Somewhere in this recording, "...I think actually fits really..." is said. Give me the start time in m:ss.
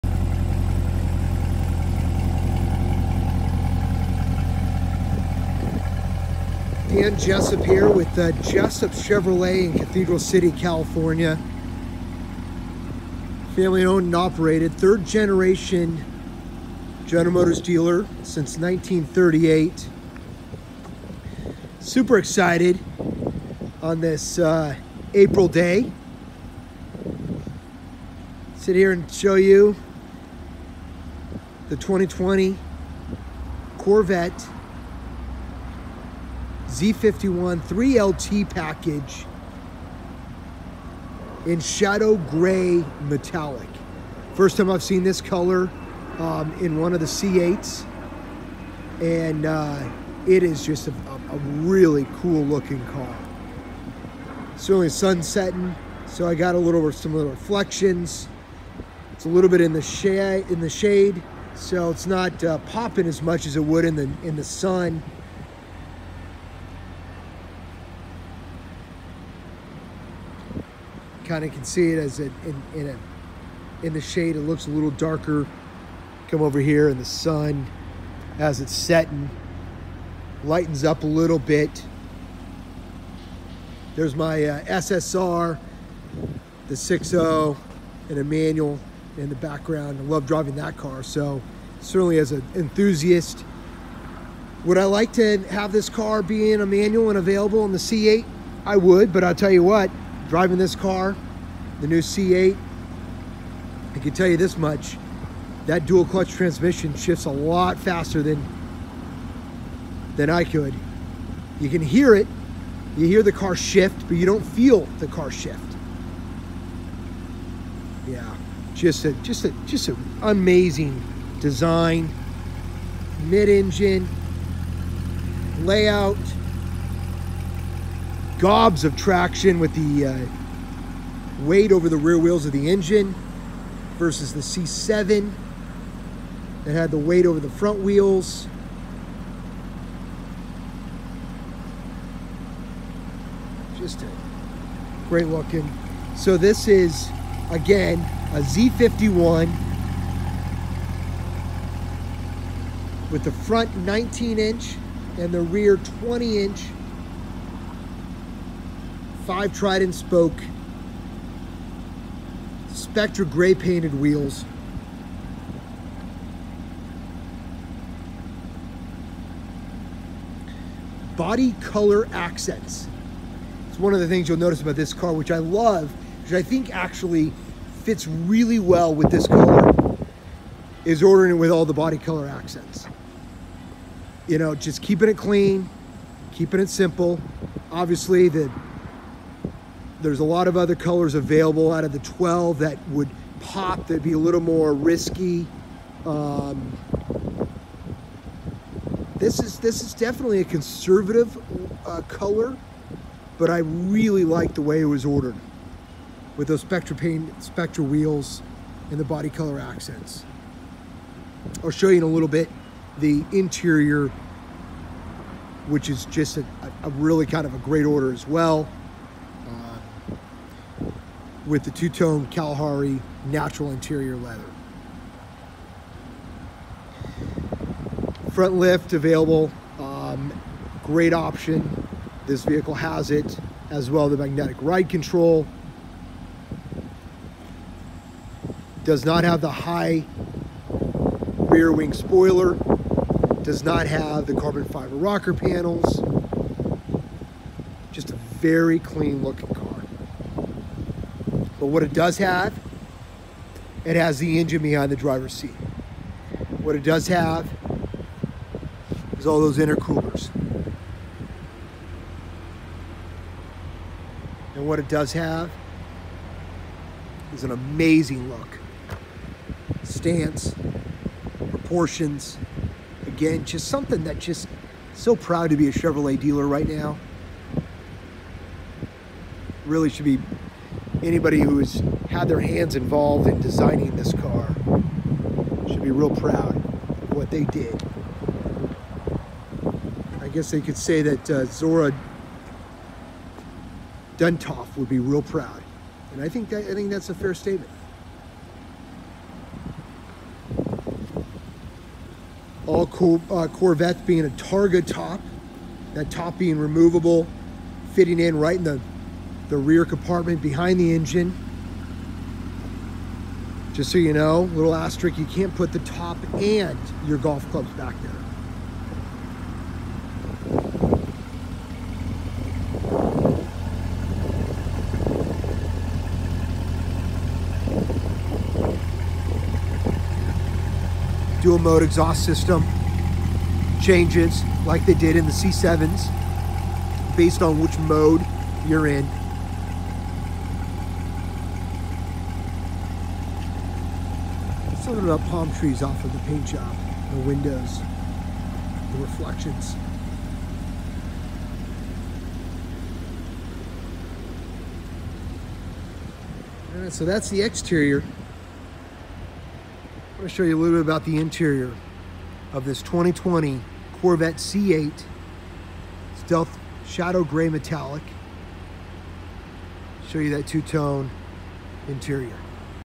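2:56.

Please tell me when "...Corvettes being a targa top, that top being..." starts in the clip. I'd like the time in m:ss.
5:03.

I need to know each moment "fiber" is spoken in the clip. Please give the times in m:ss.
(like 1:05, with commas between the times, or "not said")
4:04.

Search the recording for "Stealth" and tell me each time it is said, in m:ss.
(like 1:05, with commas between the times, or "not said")
6:06.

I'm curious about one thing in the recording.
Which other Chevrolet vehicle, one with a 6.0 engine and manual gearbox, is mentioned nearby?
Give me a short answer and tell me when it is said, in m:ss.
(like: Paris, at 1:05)
SSR, at 1:24.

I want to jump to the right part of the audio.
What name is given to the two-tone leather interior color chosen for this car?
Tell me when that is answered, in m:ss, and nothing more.
3:42.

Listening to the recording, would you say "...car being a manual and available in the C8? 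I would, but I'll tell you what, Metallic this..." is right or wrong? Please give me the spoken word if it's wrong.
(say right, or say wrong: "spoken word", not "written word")
wrong: "Driving", not "Metallic".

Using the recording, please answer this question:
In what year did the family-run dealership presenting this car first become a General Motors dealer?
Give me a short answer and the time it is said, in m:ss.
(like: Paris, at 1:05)
1938, at 0:18.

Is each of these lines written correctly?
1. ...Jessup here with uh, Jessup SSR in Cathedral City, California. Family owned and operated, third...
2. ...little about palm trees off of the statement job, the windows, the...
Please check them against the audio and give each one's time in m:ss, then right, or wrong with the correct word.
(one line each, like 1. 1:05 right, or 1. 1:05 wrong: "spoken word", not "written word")
1. 0:07 wrong: "Chevrolet", not "SSR"
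2. 5:44 wrong: "paint", not "statement".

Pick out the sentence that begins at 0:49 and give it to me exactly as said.
And uh, it is just a, a, really cool looking car.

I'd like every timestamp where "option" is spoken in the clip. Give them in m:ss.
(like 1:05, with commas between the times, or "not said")
3:51.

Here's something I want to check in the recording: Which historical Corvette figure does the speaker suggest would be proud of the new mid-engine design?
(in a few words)
Zora Duntov.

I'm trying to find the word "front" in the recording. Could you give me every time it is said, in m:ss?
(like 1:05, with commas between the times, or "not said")
2:17, 2:33, 3:48.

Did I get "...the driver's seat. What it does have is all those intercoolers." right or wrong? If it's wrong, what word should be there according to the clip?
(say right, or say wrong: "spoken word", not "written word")
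right.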